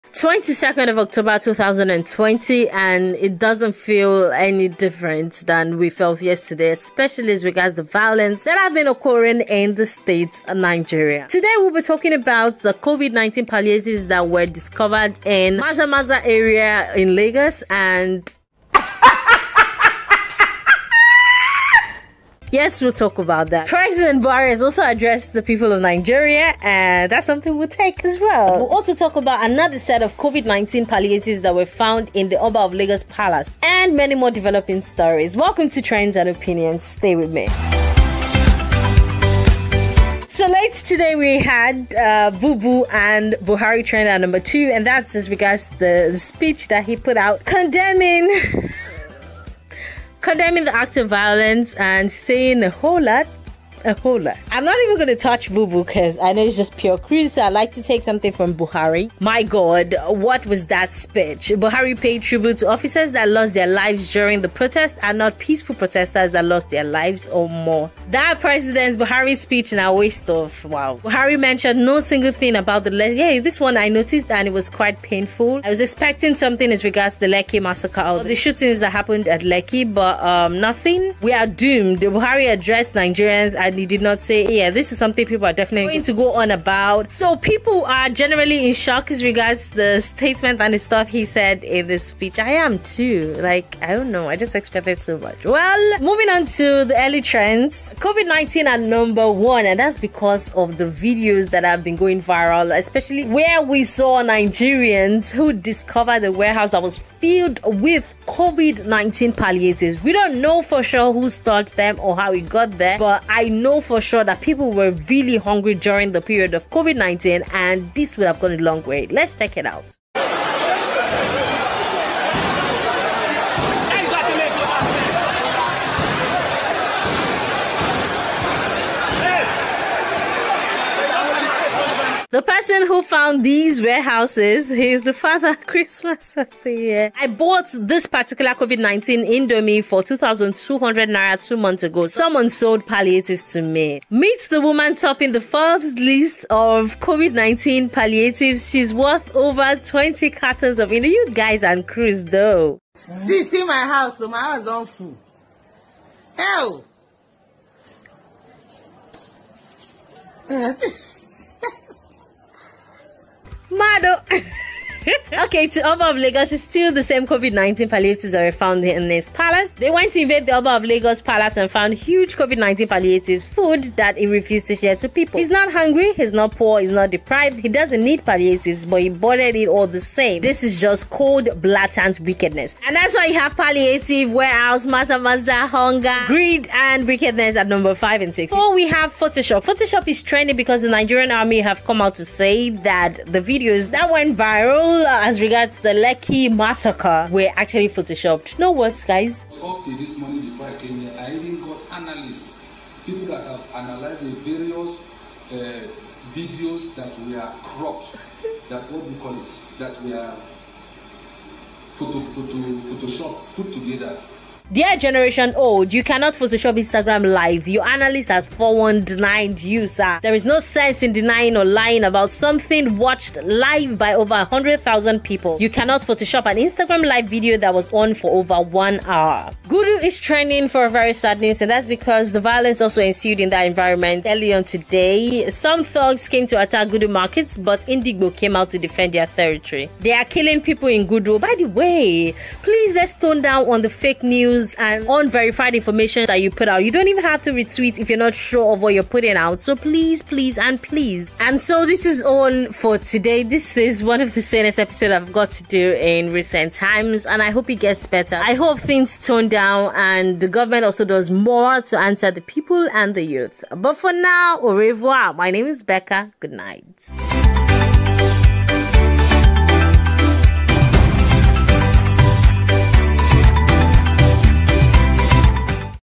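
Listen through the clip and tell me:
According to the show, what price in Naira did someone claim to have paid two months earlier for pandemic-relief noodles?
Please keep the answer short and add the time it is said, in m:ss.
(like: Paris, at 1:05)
2,200 Naira, at 2:20.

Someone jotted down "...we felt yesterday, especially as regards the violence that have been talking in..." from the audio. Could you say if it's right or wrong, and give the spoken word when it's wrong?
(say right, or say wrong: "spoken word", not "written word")
wrong: "occurring", not "talking".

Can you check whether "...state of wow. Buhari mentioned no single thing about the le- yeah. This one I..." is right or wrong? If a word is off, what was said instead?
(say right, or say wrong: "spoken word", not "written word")
wrong: "waste", not "state".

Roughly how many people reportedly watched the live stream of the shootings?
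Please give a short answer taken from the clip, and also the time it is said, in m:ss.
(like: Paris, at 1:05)
Over 100,000, at 3:44.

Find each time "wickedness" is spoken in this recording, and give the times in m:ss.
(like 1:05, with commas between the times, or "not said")
3:02, 3:07.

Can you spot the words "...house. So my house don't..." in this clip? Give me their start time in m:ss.
2:33.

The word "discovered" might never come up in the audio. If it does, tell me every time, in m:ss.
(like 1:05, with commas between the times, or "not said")
0:14, 1:45.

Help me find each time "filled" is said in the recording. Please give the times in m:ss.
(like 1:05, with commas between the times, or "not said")
1:46.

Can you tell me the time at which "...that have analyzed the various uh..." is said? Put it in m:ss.
3:23.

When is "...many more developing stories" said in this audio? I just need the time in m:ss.
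0:33.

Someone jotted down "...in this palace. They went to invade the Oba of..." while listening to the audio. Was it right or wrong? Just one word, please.
right.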